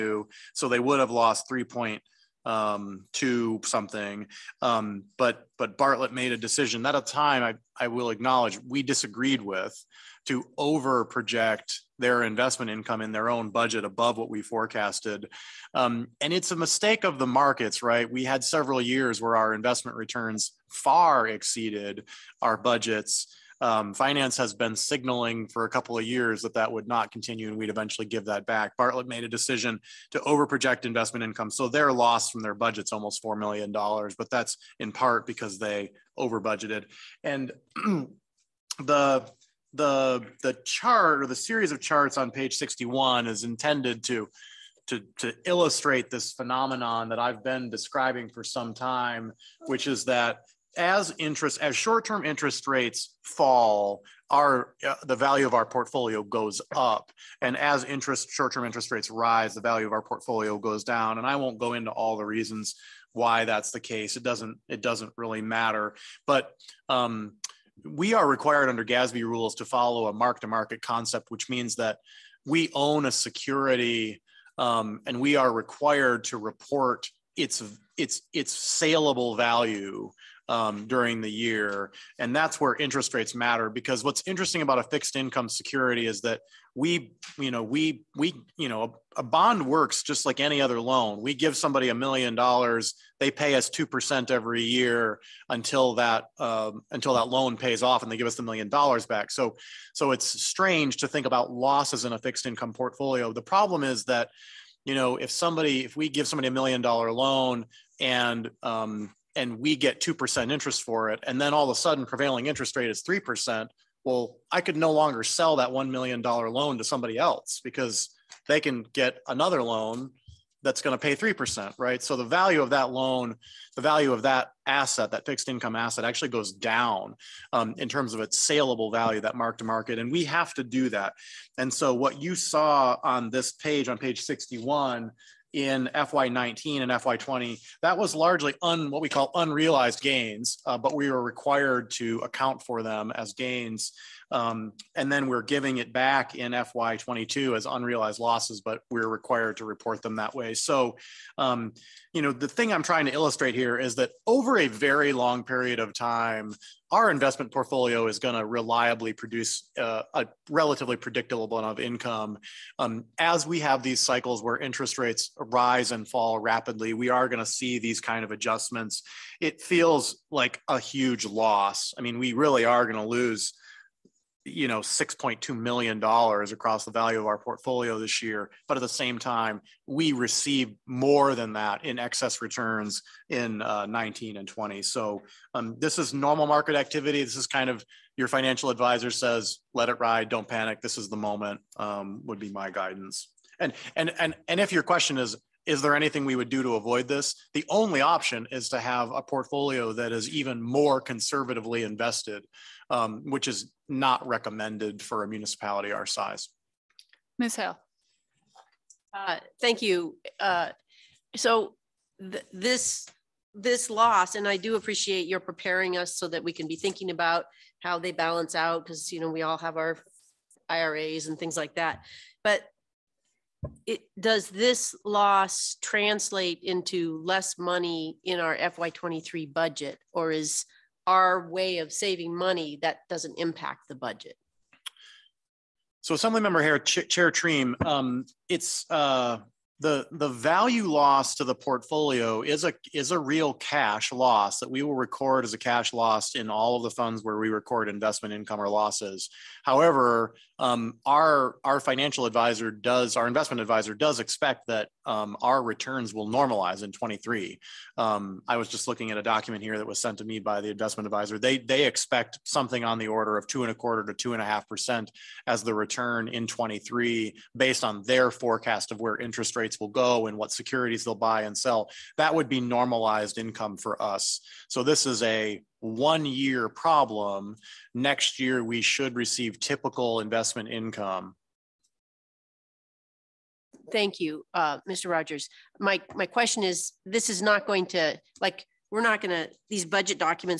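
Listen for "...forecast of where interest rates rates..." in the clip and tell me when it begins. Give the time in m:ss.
4:28.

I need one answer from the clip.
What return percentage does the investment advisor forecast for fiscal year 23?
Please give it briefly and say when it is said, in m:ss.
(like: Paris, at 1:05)
2.25 to 2.5 percent, at 4:23.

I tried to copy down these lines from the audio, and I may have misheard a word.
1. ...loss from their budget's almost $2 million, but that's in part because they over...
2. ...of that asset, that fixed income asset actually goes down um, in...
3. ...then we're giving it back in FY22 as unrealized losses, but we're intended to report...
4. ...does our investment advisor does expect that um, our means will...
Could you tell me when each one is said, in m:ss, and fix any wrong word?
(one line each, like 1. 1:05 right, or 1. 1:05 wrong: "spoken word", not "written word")
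1. 0:31 wrong: "4", not "2"
2. 2:04 right
3. 2:25 wrong: "required", not "intended"
4. 4:12 wrong: "returns", not "means".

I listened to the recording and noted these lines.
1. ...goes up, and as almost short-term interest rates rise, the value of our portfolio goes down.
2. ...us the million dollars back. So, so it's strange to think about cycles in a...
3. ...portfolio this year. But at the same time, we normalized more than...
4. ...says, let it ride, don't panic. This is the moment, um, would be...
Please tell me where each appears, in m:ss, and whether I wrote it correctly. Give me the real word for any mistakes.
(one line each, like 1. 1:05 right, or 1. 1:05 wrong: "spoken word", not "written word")
1. 0:56 wrong: "interest", not "almost"
2. 1:38 wrong: "losses", not "cycles"
3. 2:57 wrong: "received", not "normalized"
4. 3:09 right.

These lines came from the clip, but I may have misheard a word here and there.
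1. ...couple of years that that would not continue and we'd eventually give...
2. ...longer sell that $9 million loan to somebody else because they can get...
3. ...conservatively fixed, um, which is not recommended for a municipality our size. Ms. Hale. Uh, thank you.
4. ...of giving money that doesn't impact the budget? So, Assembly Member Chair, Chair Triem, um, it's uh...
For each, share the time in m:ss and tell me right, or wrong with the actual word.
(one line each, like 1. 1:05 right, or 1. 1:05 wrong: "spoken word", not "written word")
1. 0:25 right
2. 1:54 wrong: "1", not "9"
3. 3:21 wrong: "invested", not "fixed"
4. 3:51 wrong: "saving", not "giving".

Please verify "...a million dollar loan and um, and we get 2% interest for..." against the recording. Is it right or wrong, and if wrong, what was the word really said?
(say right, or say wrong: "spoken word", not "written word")
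right.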